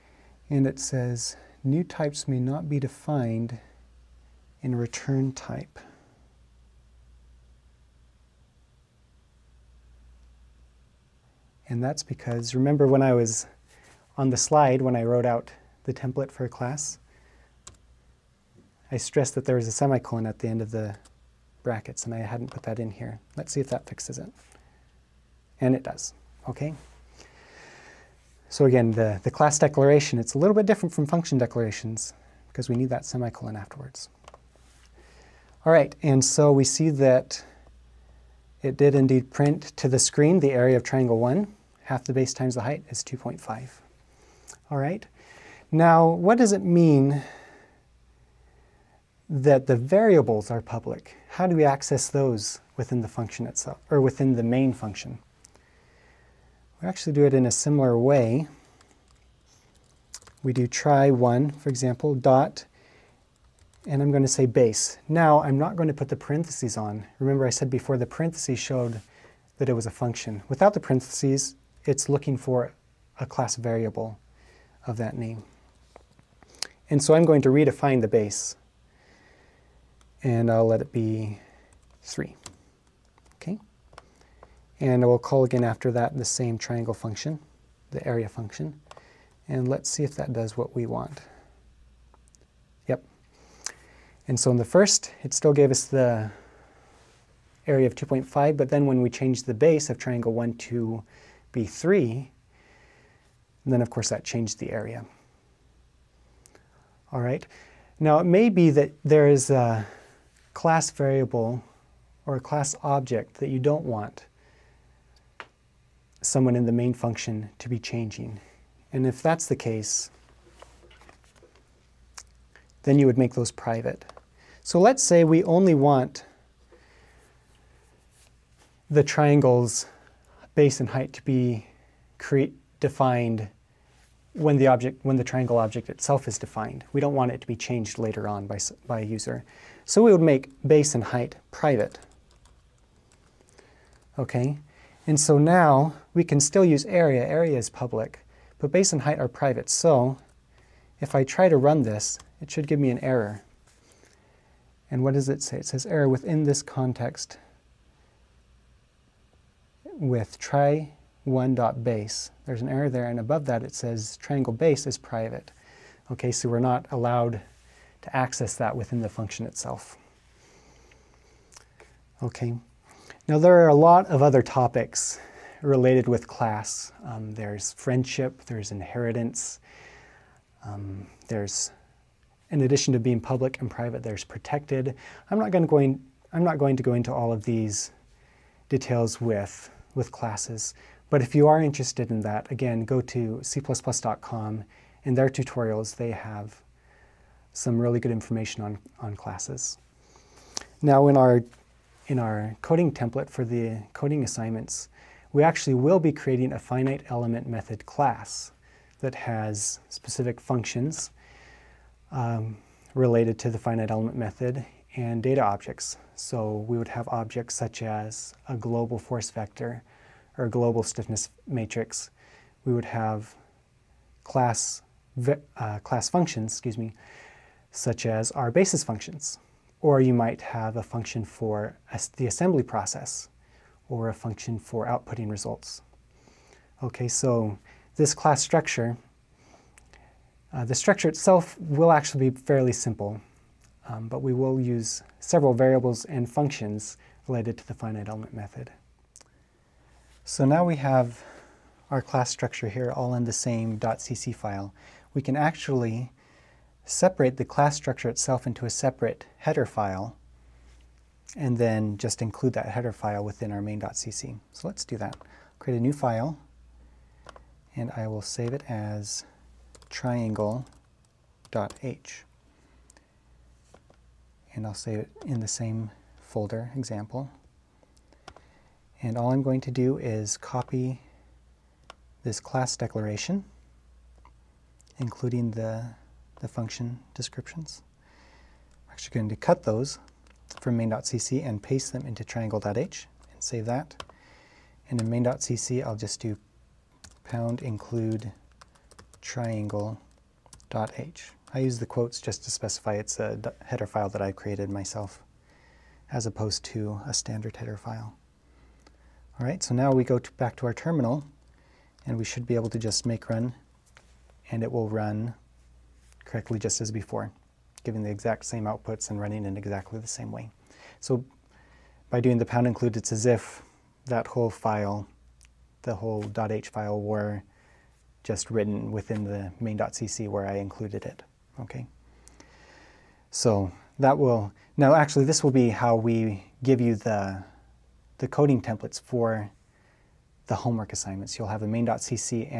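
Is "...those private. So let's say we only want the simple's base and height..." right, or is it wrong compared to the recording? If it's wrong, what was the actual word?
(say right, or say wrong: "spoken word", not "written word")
wrong: "triangle", not "simple".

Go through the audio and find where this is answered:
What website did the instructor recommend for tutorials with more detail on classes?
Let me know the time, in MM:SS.
03:13.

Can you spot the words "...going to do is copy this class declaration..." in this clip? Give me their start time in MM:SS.
04:39.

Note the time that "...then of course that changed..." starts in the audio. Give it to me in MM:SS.
01:43.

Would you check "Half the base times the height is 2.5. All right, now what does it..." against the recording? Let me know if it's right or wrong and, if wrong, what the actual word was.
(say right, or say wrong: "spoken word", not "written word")
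right.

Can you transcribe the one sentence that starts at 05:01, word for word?
I use the quotes just to specify it's a header file that I created myself as opposed to a standard header file.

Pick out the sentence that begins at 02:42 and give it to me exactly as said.
There's an error there, and above that it says triangle base is private.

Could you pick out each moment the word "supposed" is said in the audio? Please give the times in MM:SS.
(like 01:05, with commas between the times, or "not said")
not said.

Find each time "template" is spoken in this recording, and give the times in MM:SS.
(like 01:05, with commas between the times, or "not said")
00:15, 03:22, 05:38.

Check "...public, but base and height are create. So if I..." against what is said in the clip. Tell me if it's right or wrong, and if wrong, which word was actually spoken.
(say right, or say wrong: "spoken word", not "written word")
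wrong: "private", not "create".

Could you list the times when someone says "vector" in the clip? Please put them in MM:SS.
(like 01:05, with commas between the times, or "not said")
03:39.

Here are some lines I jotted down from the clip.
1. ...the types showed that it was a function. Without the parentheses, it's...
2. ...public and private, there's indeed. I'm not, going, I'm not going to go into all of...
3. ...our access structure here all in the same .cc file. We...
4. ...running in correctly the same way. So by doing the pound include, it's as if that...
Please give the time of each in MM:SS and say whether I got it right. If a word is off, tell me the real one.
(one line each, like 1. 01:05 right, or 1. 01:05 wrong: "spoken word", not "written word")
1. 01:07 wrong: "parentheses", not "types"
2. 03:03 wrong: "protected", not "indeed"
3. 04:11 wrong: "class", not "access"
4. 05:19 wrong: "exactly", not "correctly".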